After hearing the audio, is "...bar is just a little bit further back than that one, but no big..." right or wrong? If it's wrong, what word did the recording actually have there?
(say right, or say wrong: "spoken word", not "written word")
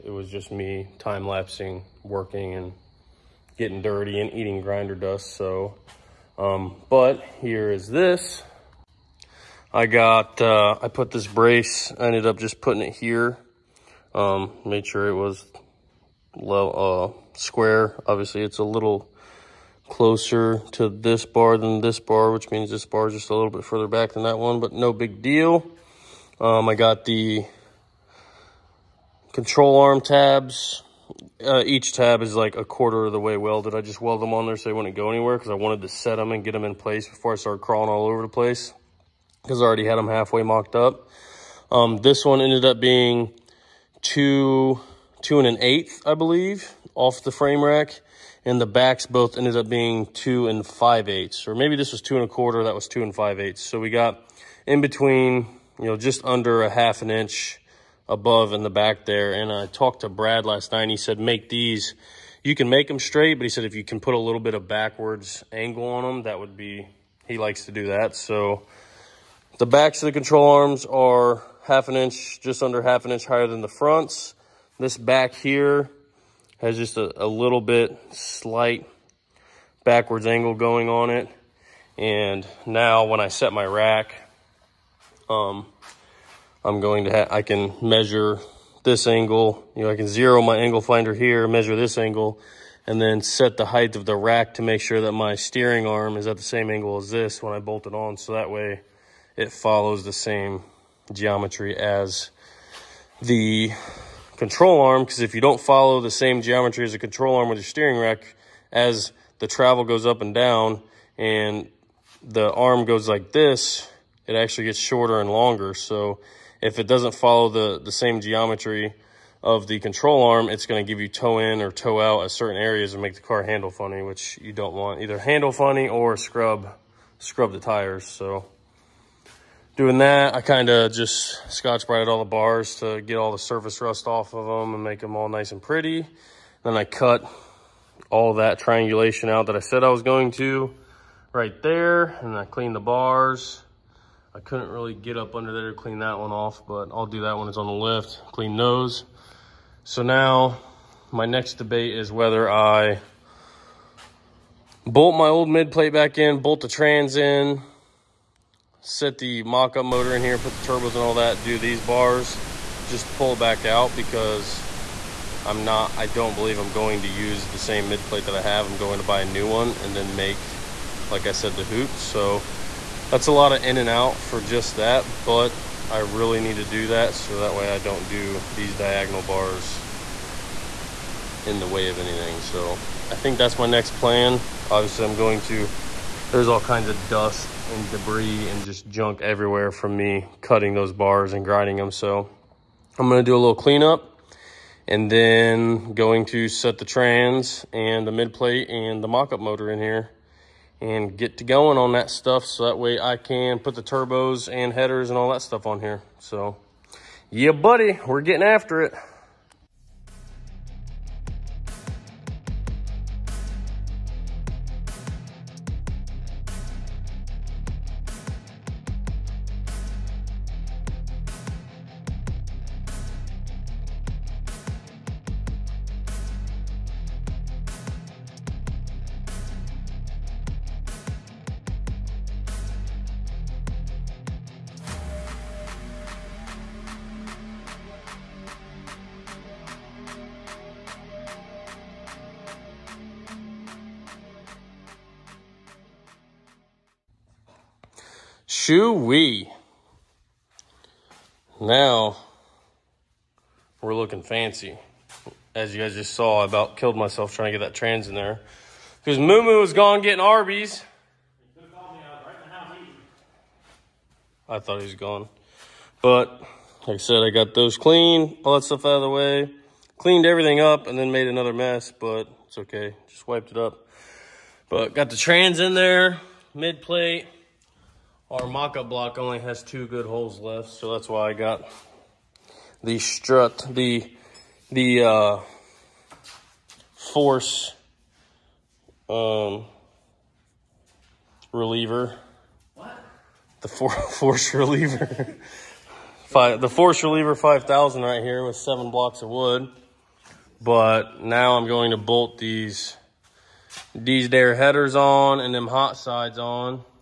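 right.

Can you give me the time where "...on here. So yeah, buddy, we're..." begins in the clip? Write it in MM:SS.
03:25.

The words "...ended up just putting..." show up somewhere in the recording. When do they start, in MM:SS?
00:12.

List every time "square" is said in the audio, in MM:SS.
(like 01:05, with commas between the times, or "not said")
00:17.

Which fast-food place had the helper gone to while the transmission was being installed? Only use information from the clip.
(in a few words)
Arby's.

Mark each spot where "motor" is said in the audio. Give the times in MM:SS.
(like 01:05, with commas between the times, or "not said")
02:39, 03:19.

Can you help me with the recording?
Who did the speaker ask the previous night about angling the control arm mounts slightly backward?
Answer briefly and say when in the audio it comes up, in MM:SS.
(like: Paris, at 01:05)
Brad, at 01:00.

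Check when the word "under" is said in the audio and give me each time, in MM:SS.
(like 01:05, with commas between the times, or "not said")
00:56, 01:12, 02:25.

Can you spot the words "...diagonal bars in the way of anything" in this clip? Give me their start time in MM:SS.
02:58.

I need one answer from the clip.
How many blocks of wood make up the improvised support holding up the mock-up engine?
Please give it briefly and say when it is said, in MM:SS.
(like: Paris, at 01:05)
7, at 04:58.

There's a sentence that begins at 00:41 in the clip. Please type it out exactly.
Um, this one ended up being two, two and an eighth, I believe, off the frame rack.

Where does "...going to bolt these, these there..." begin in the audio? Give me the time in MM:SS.
05:01.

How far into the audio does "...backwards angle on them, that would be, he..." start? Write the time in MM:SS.
01:04.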